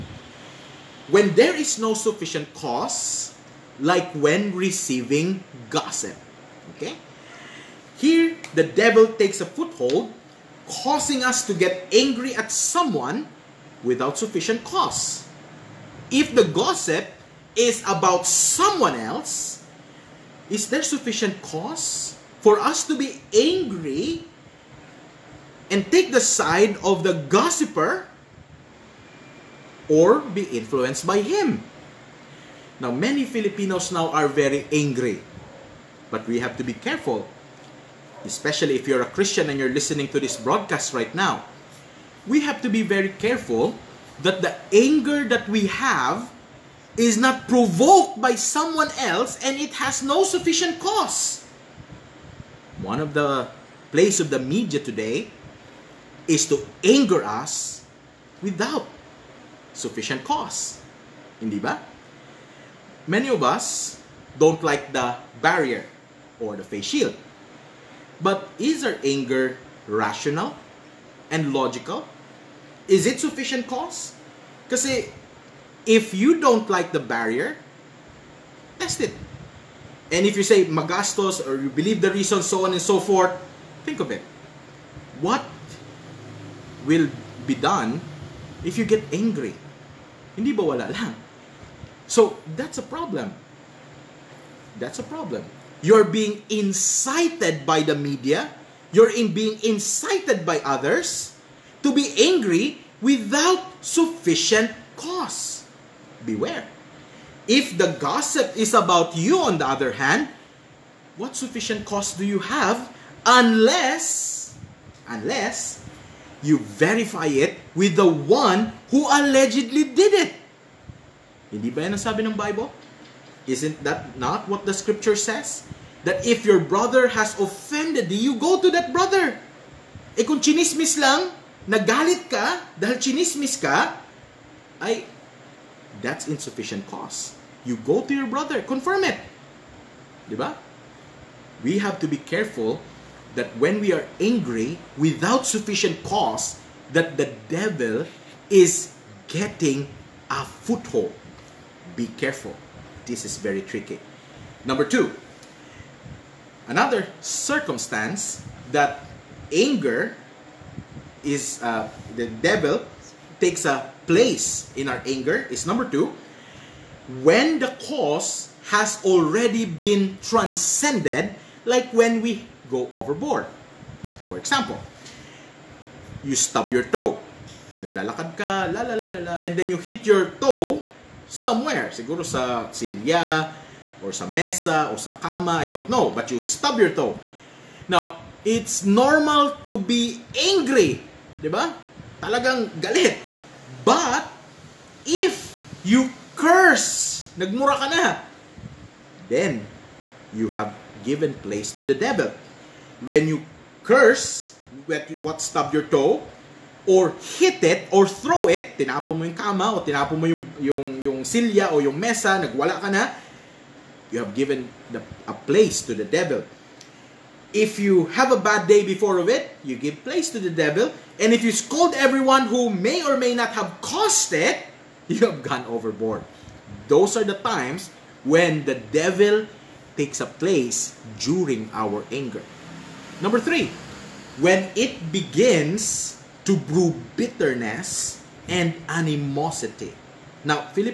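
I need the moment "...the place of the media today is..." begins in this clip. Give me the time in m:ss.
0:53.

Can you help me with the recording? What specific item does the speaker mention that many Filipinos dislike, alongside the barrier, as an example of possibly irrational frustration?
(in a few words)
face shield.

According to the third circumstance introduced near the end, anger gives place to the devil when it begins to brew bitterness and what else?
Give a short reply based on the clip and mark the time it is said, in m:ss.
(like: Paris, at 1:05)
animosity, at 3:58.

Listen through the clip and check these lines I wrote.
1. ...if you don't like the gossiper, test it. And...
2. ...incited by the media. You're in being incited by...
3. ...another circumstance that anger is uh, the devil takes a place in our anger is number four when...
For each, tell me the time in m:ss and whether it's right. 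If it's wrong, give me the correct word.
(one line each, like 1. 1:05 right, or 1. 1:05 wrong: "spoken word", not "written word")
1. 1:15 wrong: "barrier", not "gossiper"
2. 1:36 right
3. 2:36 wrong: "two", not "four".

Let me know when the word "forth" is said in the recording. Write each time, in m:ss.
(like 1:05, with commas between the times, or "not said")
1:22.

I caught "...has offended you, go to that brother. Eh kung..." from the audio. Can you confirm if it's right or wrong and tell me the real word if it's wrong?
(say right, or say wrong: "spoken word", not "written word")
right.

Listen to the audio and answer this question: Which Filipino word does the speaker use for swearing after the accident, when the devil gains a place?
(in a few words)
nagmura.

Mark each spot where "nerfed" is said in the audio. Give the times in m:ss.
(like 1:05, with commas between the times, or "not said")
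not said.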